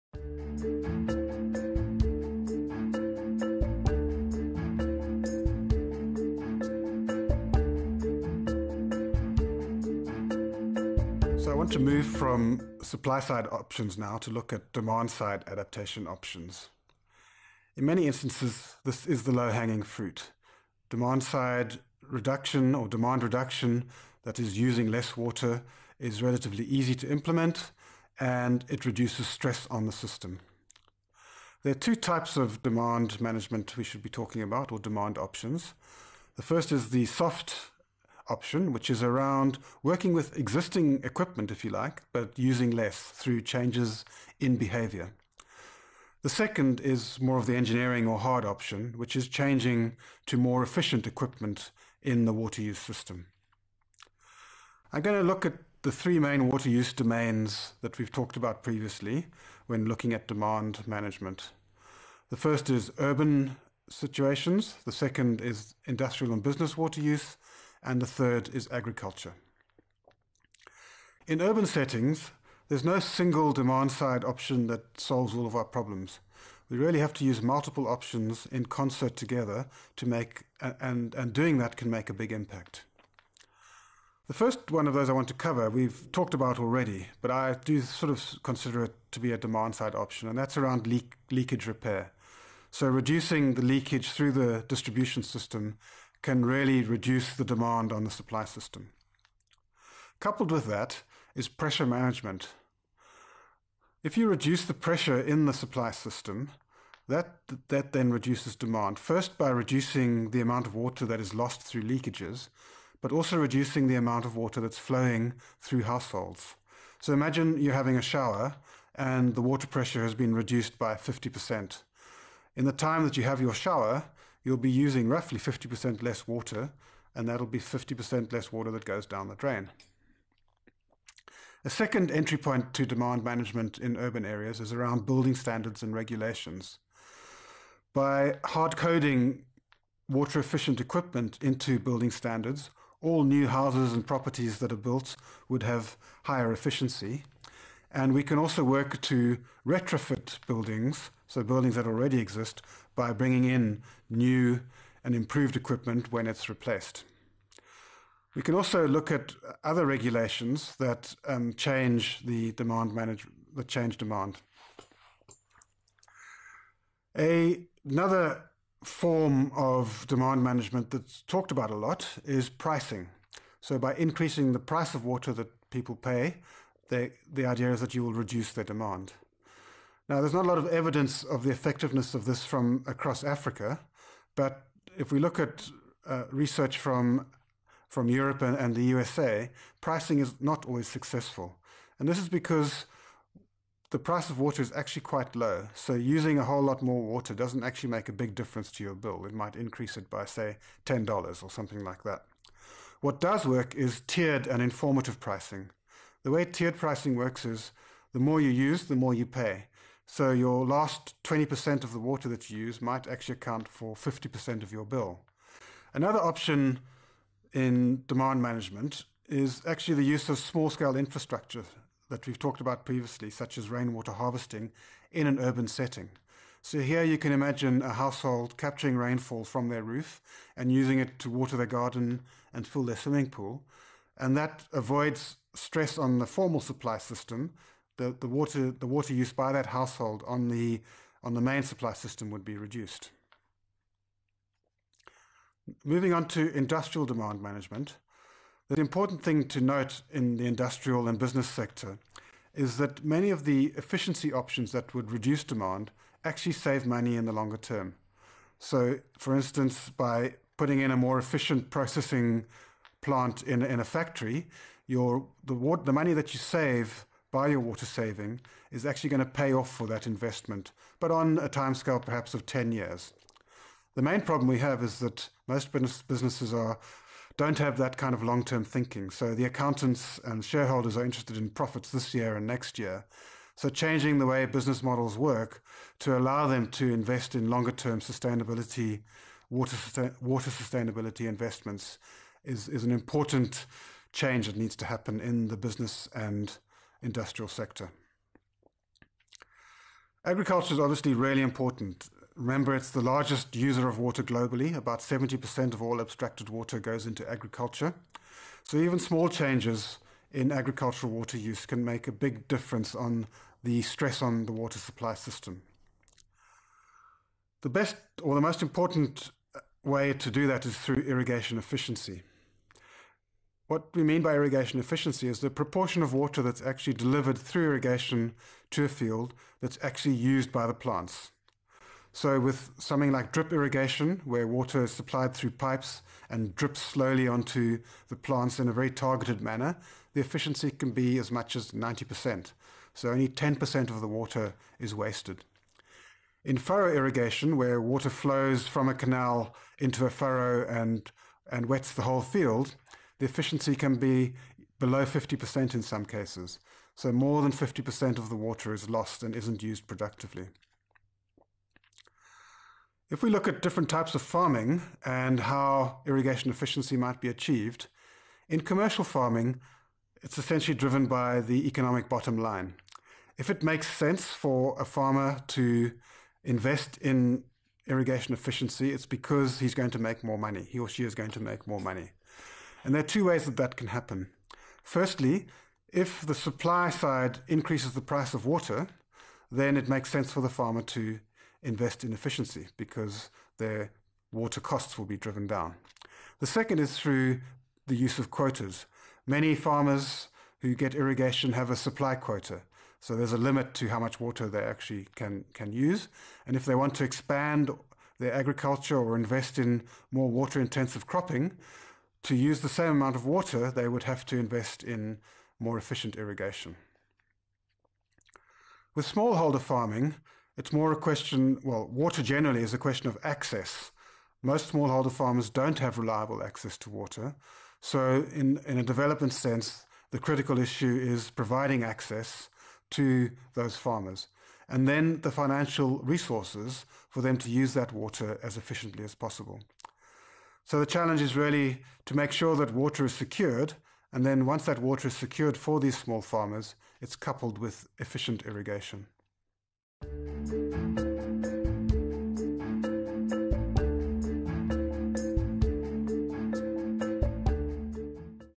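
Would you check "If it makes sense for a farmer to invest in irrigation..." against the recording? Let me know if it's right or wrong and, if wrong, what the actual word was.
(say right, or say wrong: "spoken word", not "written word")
right.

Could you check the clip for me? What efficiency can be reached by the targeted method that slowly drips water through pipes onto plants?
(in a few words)
90%.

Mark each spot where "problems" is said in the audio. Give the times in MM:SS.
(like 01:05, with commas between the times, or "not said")
01:15, 04:34.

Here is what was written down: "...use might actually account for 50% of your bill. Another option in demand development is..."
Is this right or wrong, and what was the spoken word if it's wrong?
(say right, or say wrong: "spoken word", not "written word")
wrong: "management", not "development".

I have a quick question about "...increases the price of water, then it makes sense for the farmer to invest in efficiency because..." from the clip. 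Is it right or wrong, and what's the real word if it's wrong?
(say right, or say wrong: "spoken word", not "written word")
right.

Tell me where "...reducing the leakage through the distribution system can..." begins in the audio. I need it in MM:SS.
01:32.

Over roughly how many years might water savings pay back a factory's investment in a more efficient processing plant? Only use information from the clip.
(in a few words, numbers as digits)
10 years.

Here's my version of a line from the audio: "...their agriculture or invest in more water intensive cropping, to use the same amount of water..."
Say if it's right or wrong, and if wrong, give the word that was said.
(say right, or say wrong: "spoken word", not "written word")
right.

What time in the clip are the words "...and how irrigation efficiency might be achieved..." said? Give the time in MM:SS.
06:05.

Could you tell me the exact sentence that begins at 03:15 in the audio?
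So using a whole lot more water doesn't actually make a big difference to your bill.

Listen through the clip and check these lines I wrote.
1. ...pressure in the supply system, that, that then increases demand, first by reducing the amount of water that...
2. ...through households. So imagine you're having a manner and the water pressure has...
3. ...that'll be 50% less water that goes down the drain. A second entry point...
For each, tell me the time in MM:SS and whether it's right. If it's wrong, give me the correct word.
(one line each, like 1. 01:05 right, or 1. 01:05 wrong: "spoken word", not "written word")
1. 01:44 wrong: "reduces", not "increases"
2. 01:55 wrong: "shower", not "manner"
3. 02:07 right.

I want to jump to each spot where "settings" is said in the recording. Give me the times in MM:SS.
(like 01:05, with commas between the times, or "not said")
01:11, 03:45.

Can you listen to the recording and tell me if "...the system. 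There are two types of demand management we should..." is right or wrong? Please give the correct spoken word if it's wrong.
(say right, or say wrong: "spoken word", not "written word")
right.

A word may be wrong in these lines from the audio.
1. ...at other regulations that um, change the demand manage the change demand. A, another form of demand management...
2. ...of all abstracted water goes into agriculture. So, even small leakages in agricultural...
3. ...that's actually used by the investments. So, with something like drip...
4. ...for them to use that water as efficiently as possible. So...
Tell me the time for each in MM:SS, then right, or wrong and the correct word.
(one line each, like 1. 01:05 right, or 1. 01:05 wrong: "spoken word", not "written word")
1. 02:39 right
2. 05:05 wrong: "changes", not "leakages"
3. 05:29 wrong: "plants", not "investments"
4. 07:17 right.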